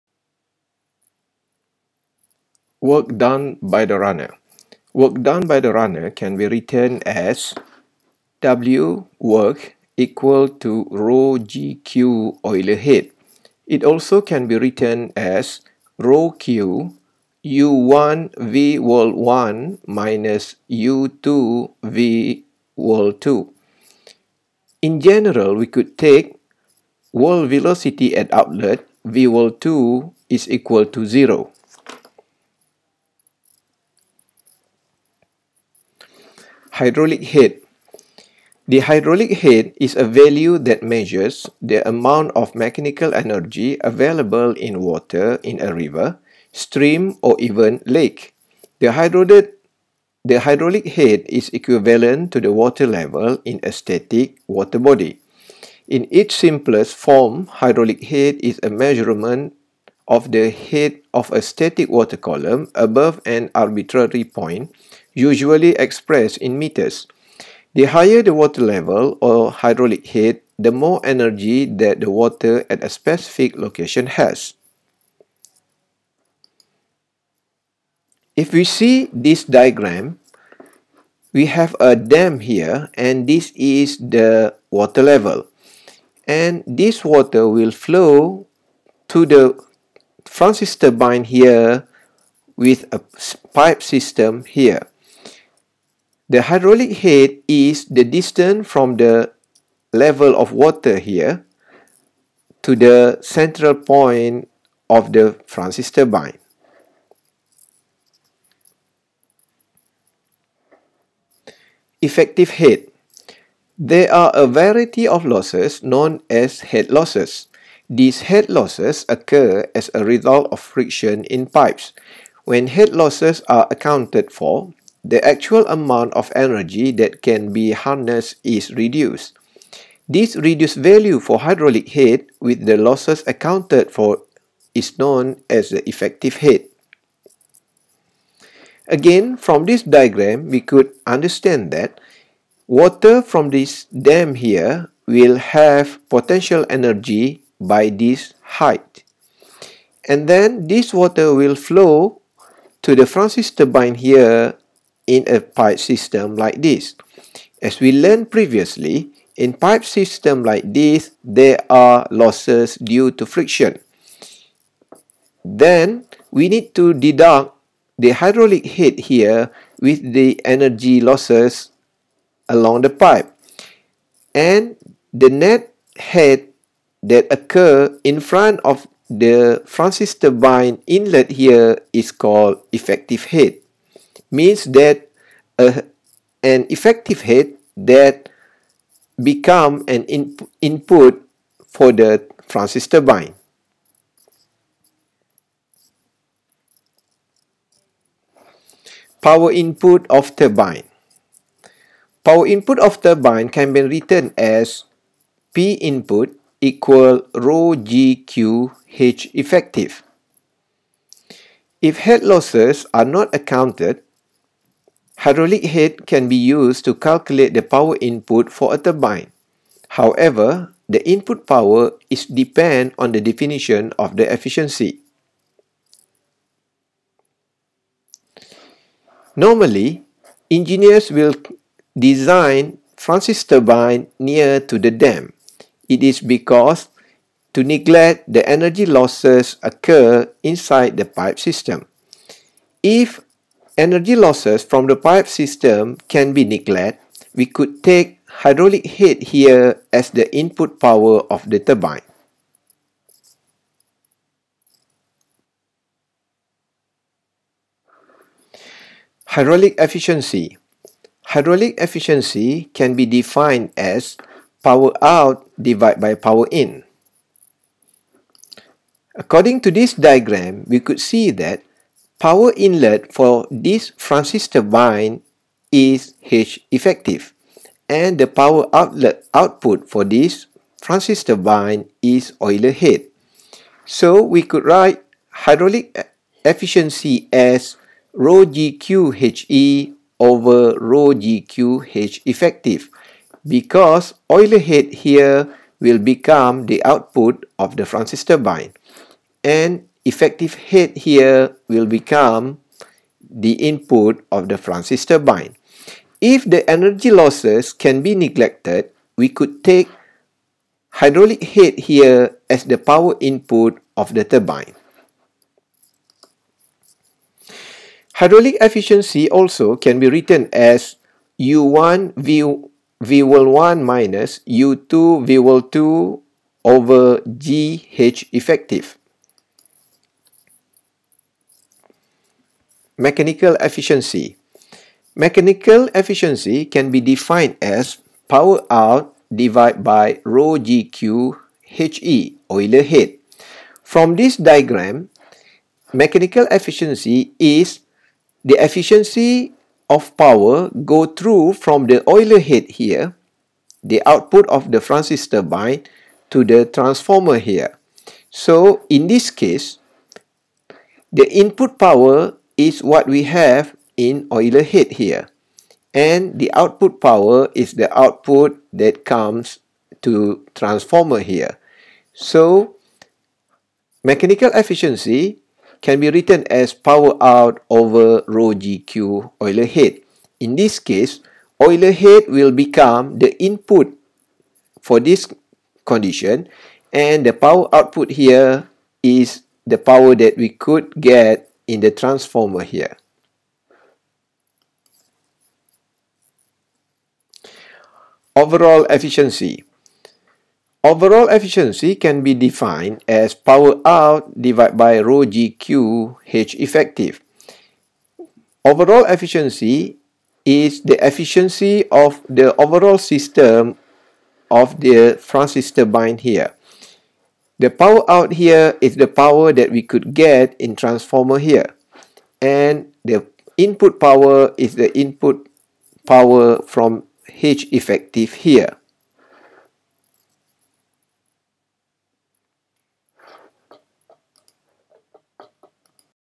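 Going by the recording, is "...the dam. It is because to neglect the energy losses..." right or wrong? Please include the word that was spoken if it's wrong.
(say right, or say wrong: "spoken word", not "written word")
right.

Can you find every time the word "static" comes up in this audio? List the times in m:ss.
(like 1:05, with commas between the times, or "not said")
0:53, 1:01.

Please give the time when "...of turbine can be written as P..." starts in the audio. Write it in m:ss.
3:22.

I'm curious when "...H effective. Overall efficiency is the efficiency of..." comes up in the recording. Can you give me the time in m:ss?
6:46.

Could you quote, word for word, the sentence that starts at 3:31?
If head losses are not accounted, Hydraulic head can be used to calculate the power input for a turbine.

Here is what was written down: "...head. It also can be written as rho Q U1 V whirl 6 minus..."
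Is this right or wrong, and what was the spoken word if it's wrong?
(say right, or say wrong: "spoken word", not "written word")
wrong: "1", not "6".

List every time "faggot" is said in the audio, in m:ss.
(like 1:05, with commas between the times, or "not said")
not said.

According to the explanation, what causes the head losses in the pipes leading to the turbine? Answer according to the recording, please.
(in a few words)
Friction in pipes.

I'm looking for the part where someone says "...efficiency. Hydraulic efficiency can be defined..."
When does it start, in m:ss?
4:19.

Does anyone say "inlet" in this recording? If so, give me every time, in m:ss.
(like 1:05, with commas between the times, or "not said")
3:00, 4:32.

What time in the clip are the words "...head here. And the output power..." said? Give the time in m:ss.
6:04.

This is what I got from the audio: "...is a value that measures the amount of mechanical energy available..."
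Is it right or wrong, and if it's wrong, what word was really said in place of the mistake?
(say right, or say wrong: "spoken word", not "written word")
right.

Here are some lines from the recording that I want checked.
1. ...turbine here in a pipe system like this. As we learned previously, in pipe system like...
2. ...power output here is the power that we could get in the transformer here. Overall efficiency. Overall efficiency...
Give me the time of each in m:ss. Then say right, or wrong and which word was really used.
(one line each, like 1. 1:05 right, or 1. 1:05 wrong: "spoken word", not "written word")
1. 2:33 right
2. 6:27 right.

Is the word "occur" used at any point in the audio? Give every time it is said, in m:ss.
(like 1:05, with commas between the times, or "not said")
1:59, 2:57, 3:59.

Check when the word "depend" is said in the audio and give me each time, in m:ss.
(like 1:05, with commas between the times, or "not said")
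3:42.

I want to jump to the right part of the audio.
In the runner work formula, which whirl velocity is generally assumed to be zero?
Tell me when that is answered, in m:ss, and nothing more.
0:27.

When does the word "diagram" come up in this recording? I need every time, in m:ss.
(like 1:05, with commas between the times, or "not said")
1:19, 2:19, 4:29, 5:44.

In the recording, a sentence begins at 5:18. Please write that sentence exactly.
Hydraulic efficiency also can be written as U1 V, v one minus U2 v 2 over GH effective.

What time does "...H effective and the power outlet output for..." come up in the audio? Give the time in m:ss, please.
4:36.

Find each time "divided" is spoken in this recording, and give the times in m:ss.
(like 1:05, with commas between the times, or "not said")
4:25, 5:39, 6:44.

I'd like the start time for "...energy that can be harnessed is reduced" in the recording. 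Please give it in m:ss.
2:06.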